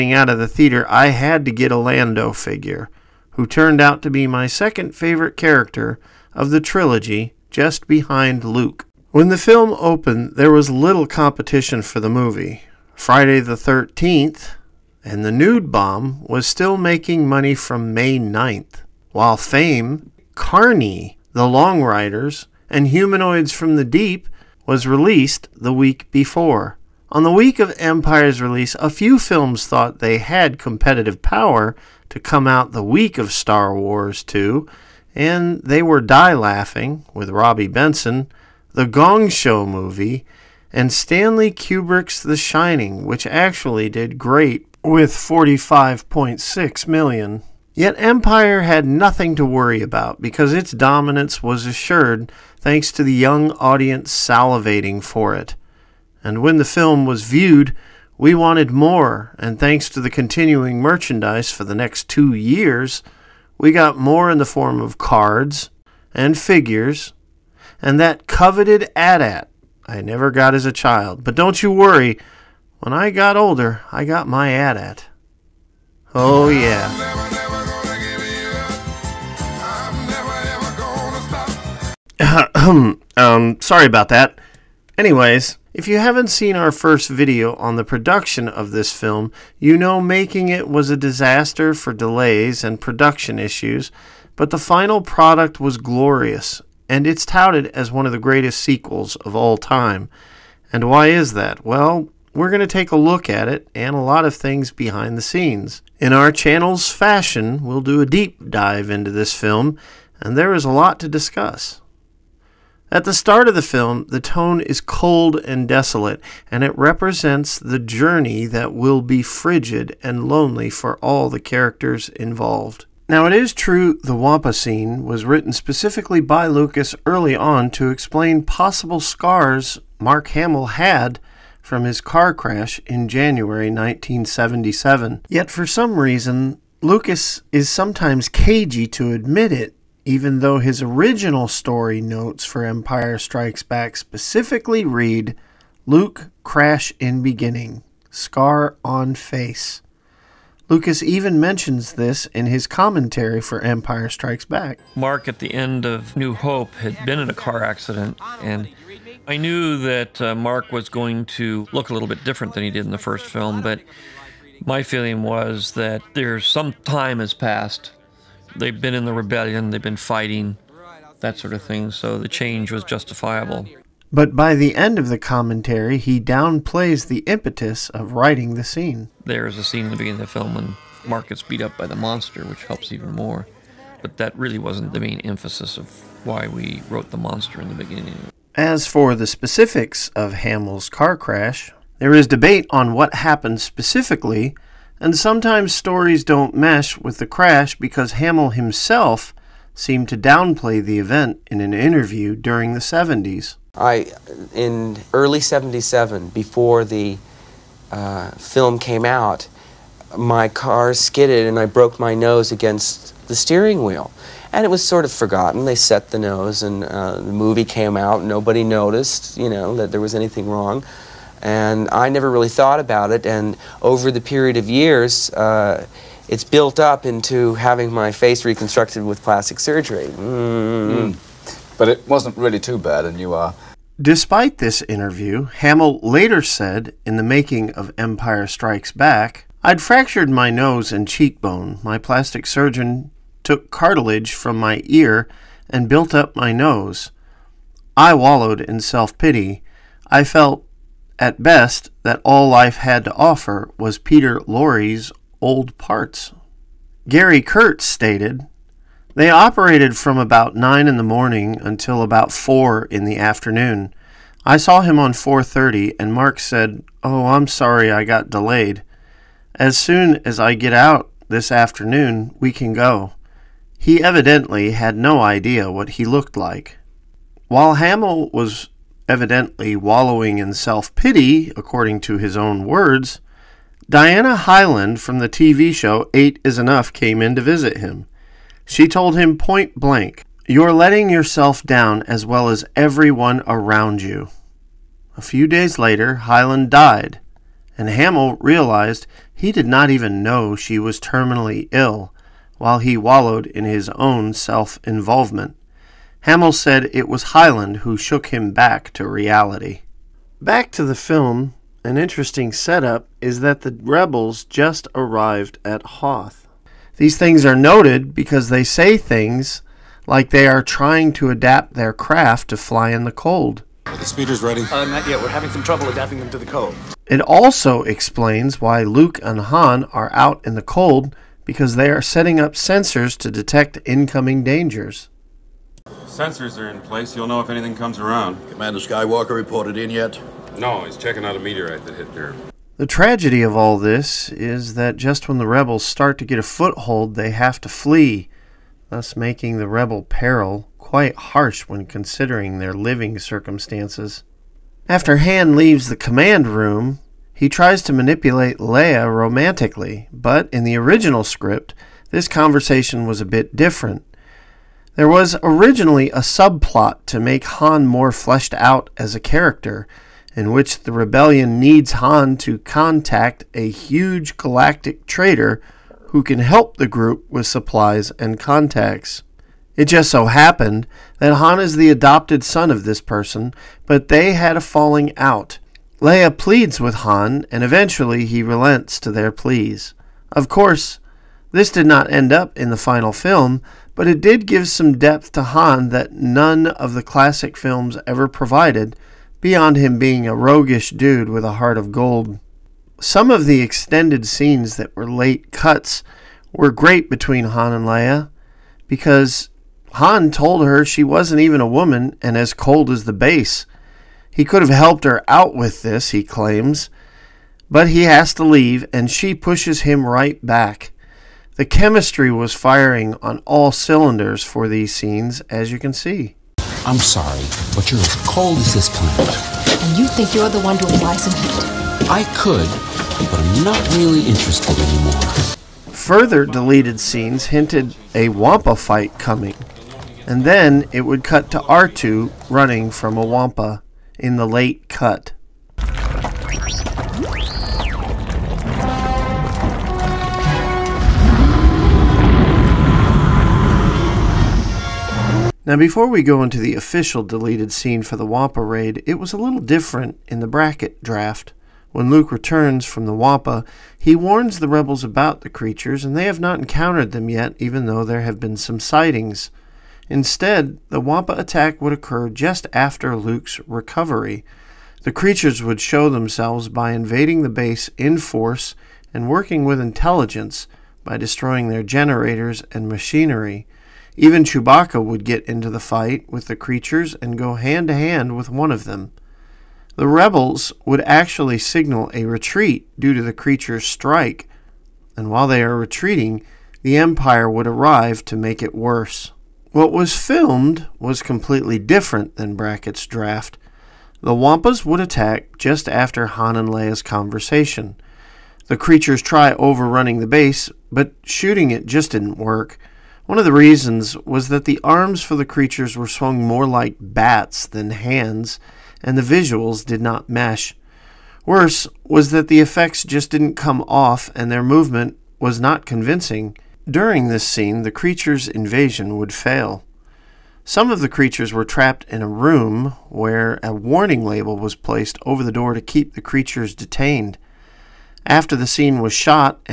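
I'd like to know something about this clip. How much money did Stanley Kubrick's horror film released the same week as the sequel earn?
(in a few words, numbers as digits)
45.6 million.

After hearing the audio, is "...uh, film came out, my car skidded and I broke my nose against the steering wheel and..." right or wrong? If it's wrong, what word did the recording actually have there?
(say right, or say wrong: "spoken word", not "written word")
right.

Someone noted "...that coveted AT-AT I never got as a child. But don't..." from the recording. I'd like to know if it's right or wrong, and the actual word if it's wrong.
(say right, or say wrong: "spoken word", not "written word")
right.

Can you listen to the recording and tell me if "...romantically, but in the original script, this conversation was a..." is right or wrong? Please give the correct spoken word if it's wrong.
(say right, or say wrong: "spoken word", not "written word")
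right.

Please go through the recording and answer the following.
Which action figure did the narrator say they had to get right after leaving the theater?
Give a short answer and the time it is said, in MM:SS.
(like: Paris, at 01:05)
Lando, at 00:01.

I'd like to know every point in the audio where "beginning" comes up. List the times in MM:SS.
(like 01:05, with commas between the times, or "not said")
02:27, 02:59, 03:07.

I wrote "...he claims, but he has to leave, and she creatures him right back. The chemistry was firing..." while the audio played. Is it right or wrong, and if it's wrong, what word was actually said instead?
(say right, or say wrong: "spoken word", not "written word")
wrong: "pushes", not "creatures".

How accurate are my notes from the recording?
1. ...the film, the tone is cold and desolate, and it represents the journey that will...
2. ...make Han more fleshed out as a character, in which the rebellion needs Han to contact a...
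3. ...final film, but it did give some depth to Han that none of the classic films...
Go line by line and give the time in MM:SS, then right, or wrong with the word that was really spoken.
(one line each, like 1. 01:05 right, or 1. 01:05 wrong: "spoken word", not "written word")
1. 01:53 right
2. 06:07 right
3. 06:32 right.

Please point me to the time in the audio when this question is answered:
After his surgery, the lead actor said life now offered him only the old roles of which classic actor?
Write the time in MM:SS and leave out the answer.
04:13.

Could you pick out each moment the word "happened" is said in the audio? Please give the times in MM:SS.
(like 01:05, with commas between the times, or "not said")
03:13, 06:20.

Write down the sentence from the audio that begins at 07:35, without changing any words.
Now before we go into the official deleted scene for the Wampa raid, it was a little different in the Brackett draft.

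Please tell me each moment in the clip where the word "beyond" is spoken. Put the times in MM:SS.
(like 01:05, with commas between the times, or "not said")
06:39.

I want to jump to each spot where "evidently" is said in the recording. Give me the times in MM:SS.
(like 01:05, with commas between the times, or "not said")
04:34, 04:39.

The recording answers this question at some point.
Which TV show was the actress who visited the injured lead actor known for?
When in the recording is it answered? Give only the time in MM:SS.
04:46.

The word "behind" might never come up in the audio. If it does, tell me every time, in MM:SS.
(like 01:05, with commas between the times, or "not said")
00:07, 01:44.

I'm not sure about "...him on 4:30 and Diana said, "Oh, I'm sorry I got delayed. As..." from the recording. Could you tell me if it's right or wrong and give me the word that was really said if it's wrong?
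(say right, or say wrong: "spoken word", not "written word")
wrong: "Mark", not "Diana".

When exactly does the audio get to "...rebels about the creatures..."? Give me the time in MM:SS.
07:44.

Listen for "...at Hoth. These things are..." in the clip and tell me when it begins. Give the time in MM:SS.
05:15.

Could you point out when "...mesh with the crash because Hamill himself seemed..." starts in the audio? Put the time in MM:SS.
03:16.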